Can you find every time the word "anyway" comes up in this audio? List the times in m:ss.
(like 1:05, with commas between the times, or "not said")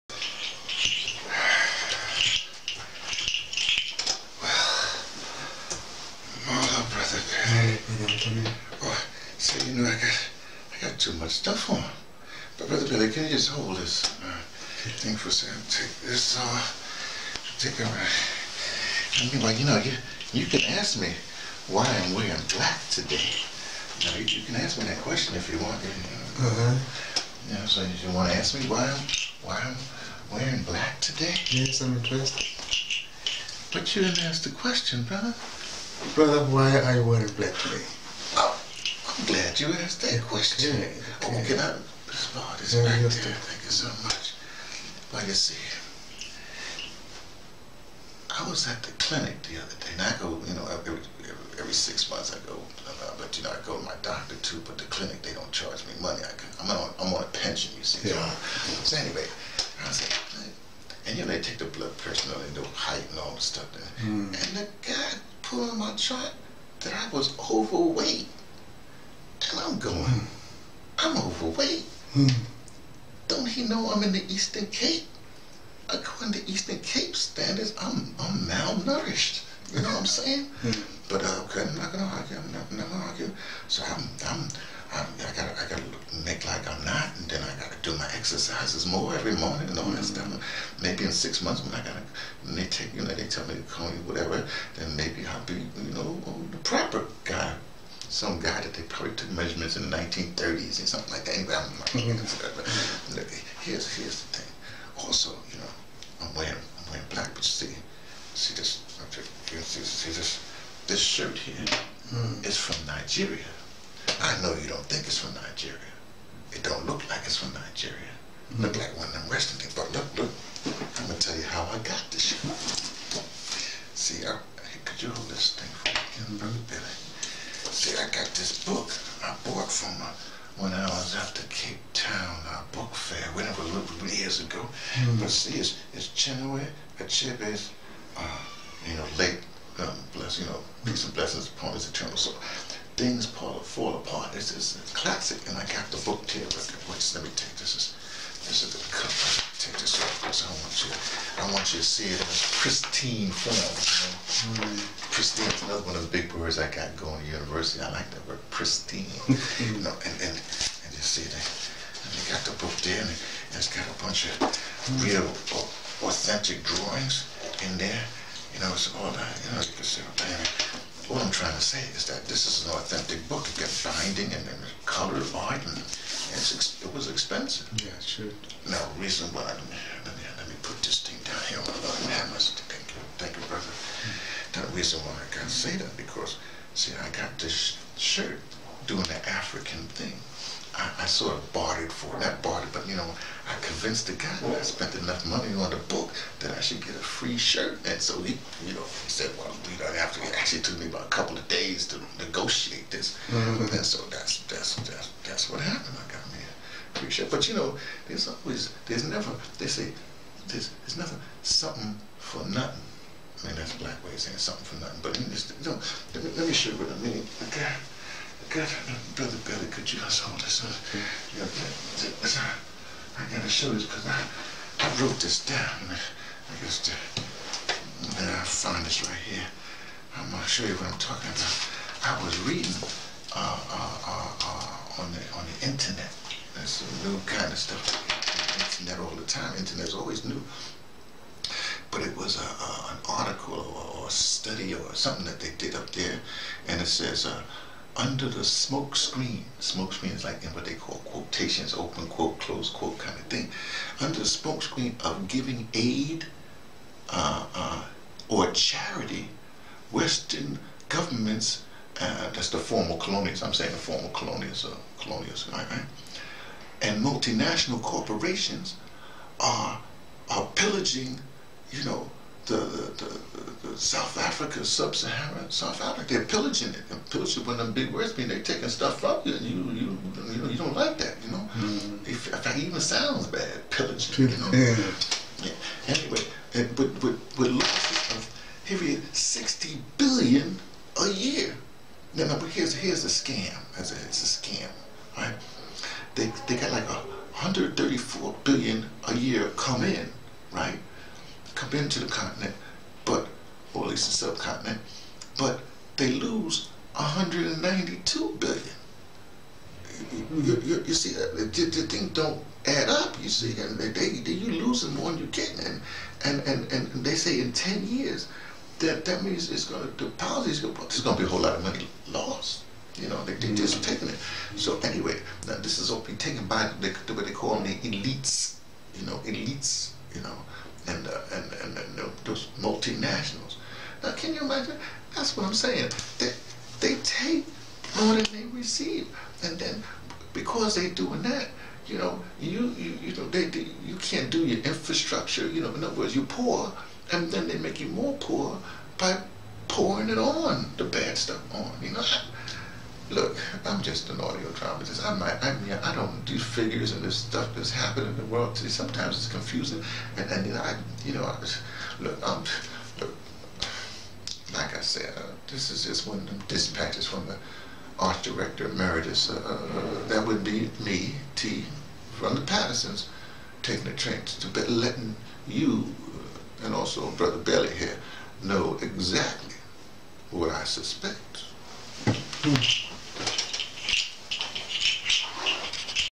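0:58, 1:41, 4:45, 5:24.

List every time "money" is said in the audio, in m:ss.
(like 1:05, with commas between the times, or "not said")
0:56, 3:15, 5:21.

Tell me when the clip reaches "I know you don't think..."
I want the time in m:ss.
1:54.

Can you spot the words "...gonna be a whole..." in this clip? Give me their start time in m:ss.
5:21.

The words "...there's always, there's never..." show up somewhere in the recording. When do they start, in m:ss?
3:28.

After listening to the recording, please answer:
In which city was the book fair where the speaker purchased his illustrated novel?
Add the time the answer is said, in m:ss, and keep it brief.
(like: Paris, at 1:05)
Cape Town, at 2:11.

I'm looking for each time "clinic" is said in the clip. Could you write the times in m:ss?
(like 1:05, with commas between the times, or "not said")
0:48, 0:54.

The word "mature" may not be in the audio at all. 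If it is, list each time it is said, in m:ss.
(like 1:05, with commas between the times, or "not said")
not said.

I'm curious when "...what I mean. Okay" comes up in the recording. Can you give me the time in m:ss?
3:36.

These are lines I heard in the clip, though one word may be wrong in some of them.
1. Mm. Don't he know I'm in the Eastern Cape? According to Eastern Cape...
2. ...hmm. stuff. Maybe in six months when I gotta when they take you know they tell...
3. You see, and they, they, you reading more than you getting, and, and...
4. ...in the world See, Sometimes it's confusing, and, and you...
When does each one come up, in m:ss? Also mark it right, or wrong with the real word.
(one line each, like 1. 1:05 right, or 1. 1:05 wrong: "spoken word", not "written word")
1. 1:12 right
2. 1:30 right
3. 5:13 wrong: "losing", not "reading"
4. 5:58 right.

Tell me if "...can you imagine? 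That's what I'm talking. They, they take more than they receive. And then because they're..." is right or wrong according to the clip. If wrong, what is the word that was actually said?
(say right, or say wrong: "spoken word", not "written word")
wrong: "saying", not "talking".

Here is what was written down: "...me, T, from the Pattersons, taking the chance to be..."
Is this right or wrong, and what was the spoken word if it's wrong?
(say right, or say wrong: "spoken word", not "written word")
right.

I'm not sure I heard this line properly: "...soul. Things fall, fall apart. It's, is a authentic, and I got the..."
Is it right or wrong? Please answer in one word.
wrong.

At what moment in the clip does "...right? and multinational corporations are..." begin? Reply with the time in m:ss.
4:25.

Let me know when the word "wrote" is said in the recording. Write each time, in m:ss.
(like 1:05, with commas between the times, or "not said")
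3:45.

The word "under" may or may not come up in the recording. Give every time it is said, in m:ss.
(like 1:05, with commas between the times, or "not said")
4:07, 4:13.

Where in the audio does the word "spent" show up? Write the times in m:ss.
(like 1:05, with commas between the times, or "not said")
3:14.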